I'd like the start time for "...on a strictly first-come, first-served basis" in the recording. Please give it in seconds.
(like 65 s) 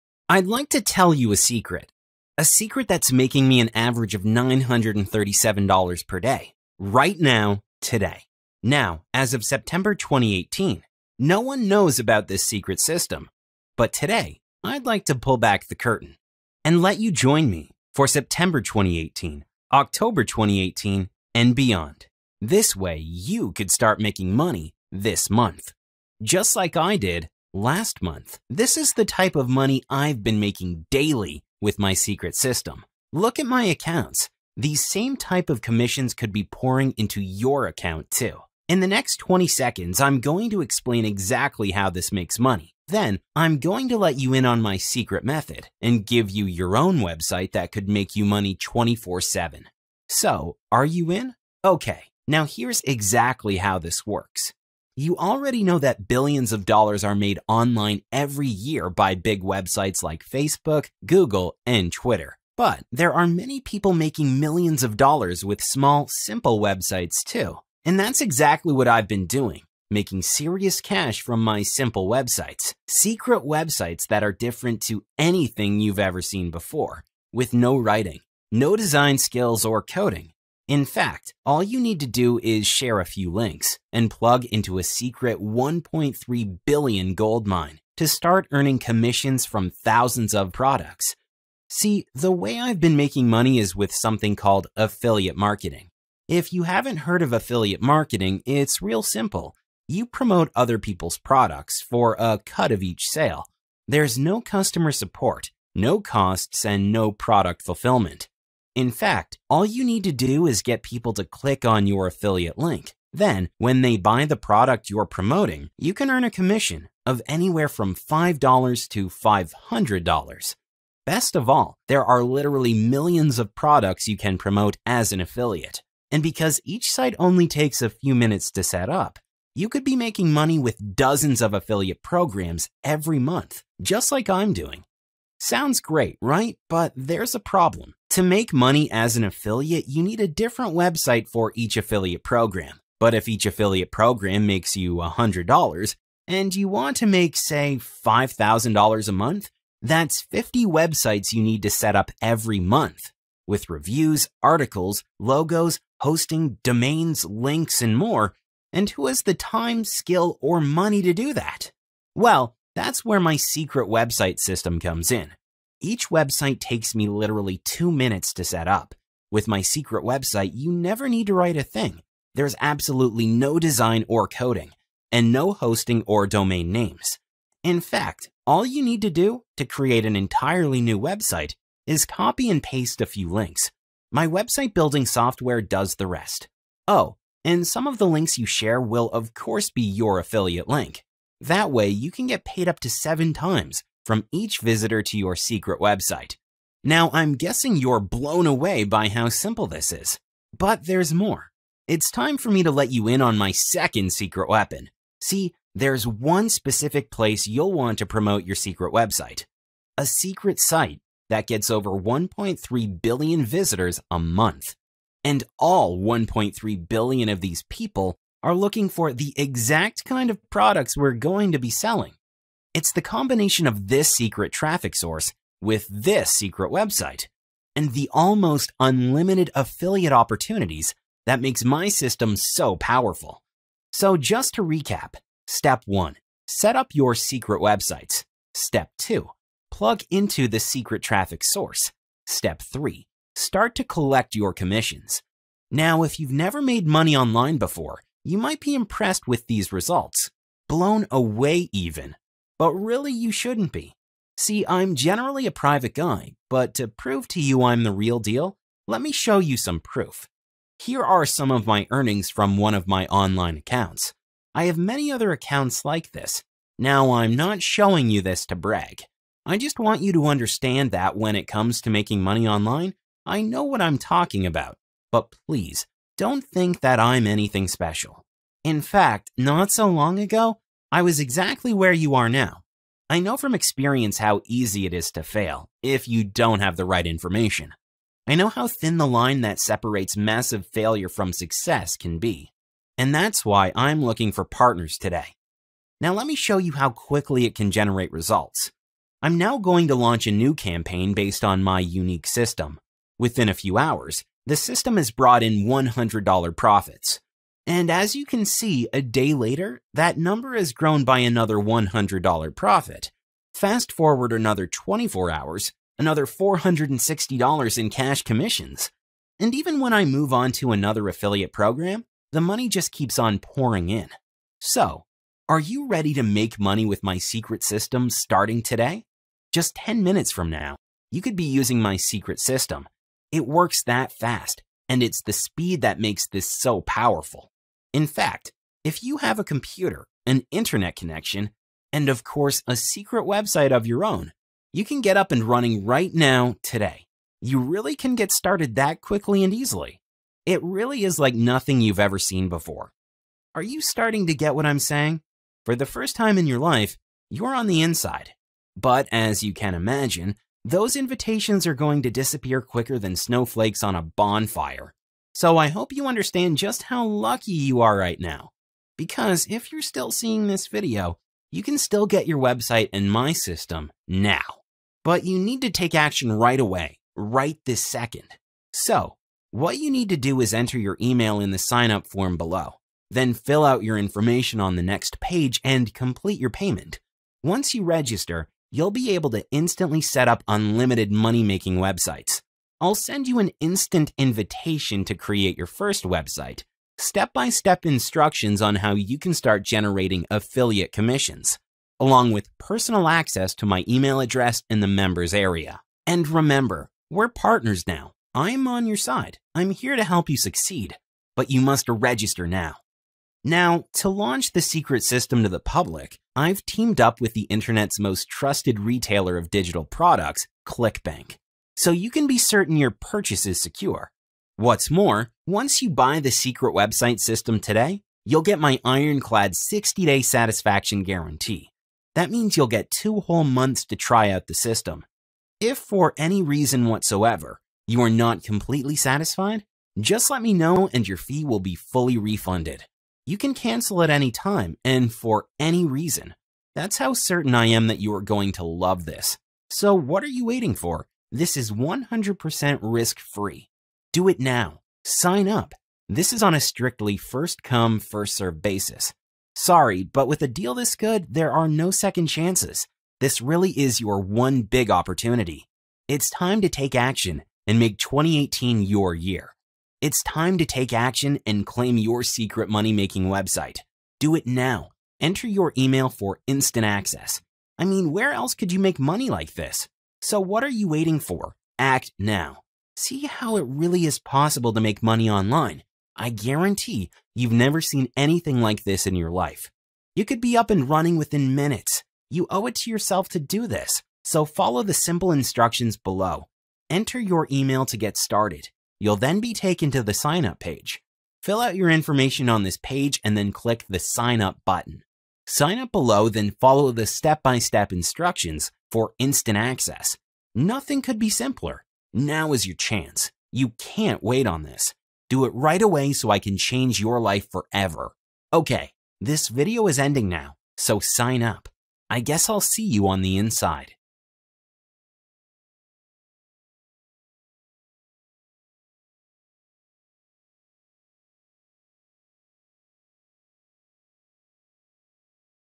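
456 s.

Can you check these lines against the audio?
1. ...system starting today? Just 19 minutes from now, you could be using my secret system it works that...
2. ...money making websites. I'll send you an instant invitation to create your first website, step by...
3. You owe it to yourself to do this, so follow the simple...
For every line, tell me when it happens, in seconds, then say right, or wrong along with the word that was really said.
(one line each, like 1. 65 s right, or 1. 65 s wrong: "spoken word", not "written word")
1. 327 s wrong: "10", not "19"
2. 391 s right
3. 492 s right.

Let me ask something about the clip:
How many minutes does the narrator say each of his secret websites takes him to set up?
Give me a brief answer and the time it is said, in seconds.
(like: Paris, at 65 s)
2, at 167 s.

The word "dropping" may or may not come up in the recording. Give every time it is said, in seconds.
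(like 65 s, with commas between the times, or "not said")
not said.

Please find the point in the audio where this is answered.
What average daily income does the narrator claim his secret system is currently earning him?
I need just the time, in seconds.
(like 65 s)
4 s.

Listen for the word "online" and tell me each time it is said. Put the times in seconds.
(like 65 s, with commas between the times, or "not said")
57 s, 247 s, 263 s, 272 s, 485 s.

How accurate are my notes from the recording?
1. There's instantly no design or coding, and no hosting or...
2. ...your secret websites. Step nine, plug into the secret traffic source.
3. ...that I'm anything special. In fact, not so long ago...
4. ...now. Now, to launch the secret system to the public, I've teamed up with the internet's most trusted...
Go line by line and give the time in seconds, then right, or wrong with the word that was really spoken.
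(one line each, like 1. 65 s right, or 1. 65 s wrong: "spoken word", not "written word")
1. 172 s wrong: "absolutely", not "instantly"
2. 236 s wrong: "two", not "nine"
3. 276 s right
4. 412 s right.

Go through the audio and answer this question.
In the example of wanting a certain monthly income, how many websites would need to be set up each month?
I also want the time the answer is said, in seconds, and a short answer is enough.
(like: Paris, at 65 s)
50, at 150 s.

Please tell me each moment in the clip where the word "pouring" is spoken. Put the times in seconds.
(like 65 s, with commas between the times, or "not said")
36 s, 323 s.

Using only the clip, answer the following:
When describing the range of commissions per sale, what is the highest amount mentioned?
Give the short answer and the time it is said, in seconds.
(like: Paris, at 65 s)
$500, at 119 s.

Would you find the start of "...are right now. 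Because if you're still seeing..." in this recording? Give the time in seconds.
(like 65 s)
367 s.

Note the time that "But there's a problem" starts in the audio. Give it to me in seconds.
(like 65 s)
136 s.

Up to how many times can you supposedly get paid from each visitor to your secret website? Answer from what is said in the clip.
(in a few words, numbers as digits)
7.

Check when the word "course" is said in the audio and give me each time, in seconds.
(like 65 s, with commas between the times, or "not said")
189 s, 342 s.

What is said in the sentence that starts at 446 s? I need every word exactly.
That's how certain I am that you are going to love this.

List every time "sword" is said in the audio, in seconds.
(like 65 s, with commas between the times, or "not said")
not said.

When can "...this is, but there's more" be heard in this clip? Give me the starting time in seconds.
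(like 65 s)
199 s.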